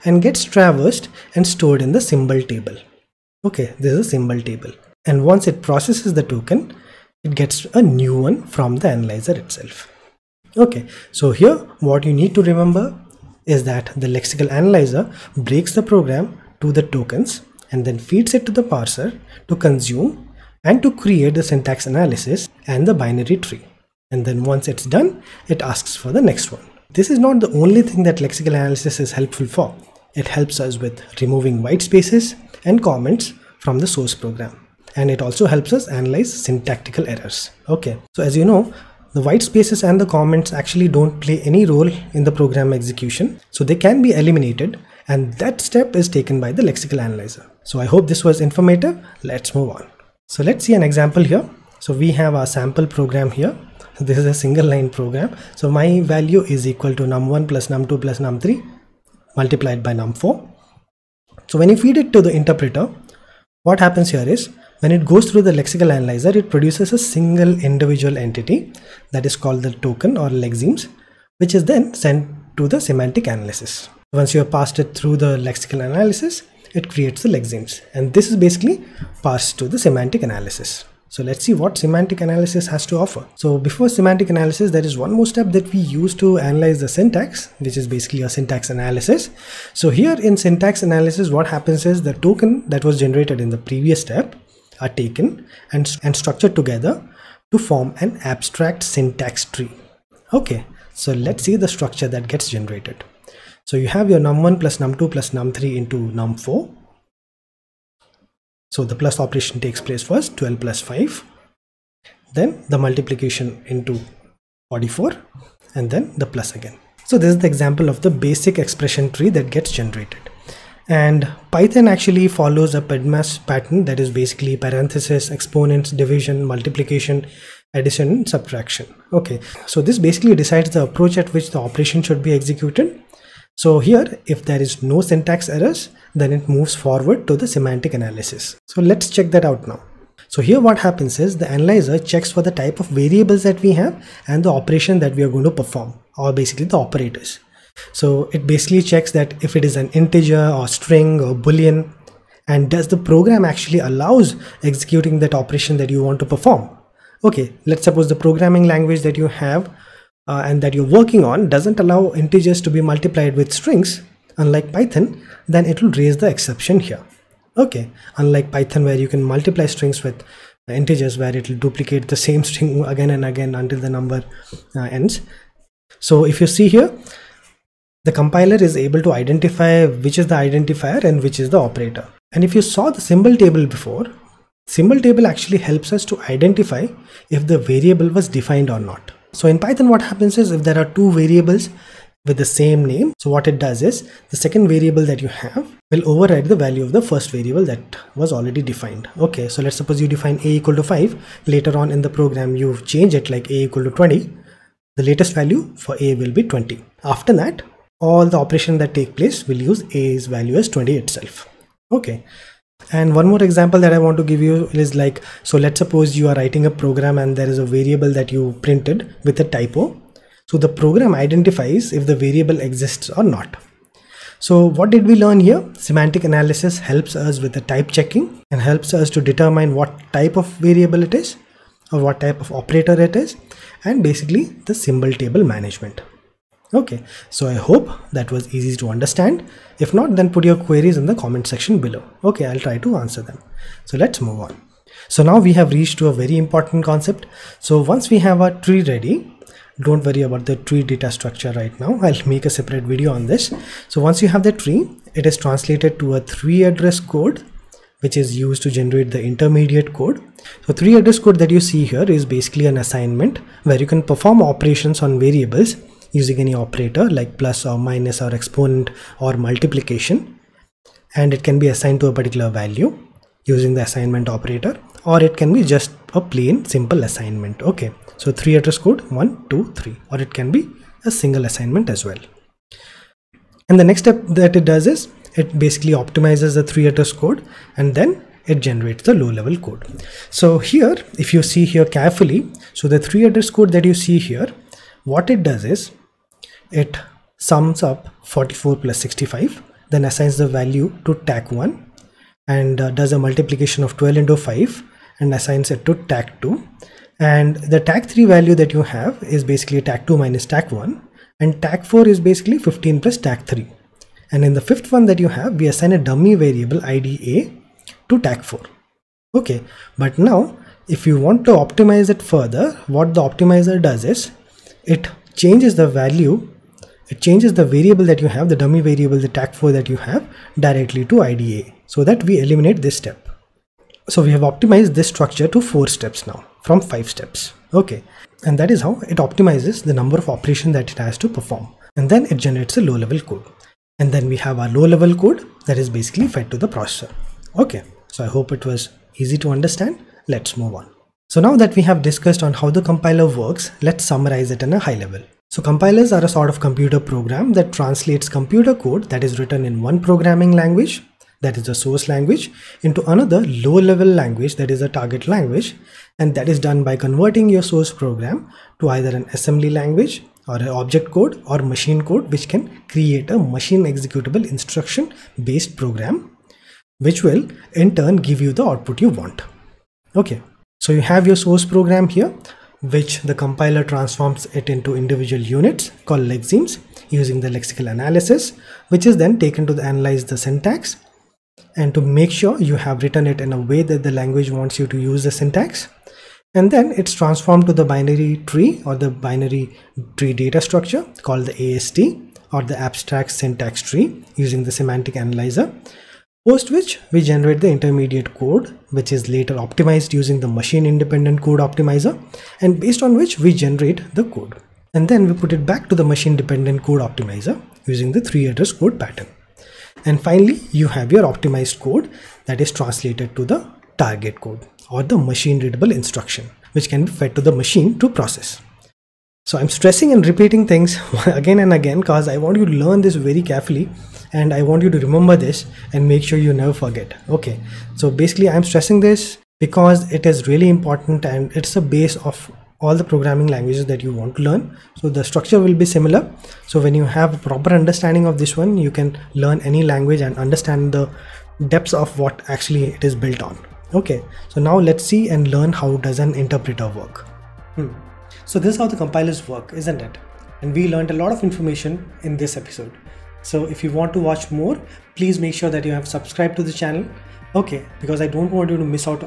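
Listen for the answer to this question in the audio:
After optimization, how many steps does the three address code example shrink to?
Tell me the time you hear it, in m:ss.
5:35.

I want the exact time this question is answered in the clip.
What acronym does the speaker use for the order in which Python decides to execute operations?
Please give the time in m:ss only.
2:02.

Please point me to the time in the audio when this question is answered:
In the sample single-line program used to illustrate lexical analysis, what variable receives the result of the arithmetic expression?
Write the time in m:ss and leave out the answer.
0:55.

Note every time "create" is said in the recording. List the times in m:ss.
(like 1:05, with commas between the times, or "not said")
0:21, 1:16, 6:12.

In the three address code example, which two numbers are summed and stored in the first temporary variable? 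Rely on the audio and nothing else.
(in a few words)
44 and 65.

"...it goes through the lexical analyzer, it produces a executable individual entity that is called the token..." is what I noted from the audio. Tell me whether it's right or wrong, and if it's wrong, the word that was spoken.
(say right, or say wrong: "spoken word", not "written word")
wrong: "single", not "executable".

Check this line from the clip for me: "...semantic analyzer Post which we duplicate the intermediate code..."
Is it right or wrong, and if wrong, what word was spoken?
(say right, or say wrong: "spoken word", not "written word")
wrong: "generate", not "duplicate".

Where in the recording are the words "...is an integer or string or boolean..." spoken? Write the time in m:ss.
2:29.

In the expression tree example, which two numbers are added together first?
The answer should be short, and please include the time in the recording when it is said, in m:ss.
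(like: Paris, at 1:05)
12 and 5, at 1:50.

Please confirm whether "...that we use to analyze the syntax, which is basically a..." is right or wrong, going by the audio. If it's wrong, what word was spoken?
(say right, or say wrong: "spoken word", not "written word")
right.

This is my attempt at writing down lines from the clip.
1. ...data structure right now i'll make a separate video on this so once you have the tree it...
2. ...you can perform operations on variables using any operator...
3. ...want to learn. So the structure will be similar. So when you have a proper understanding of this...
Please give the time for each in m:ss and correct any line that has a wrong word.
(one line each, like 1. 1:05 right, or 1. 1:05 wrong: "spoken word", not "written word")
1. 4:10 right
2. 4:23 right
3. 7:24 right.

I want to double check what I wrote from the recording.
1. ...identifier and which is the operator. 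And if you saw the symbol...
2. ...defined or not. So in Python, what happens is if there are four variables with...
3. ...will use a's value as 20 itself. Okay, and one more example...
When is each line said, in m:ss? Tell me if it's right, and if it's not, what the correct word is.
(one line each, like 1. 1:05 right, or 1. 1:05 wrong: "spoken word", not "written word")
1. 3:00 right
2. 3:08 wrong: "two", not "four"
3. 3:29 right.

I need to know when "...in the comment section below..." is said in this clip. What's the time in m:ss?
4:00.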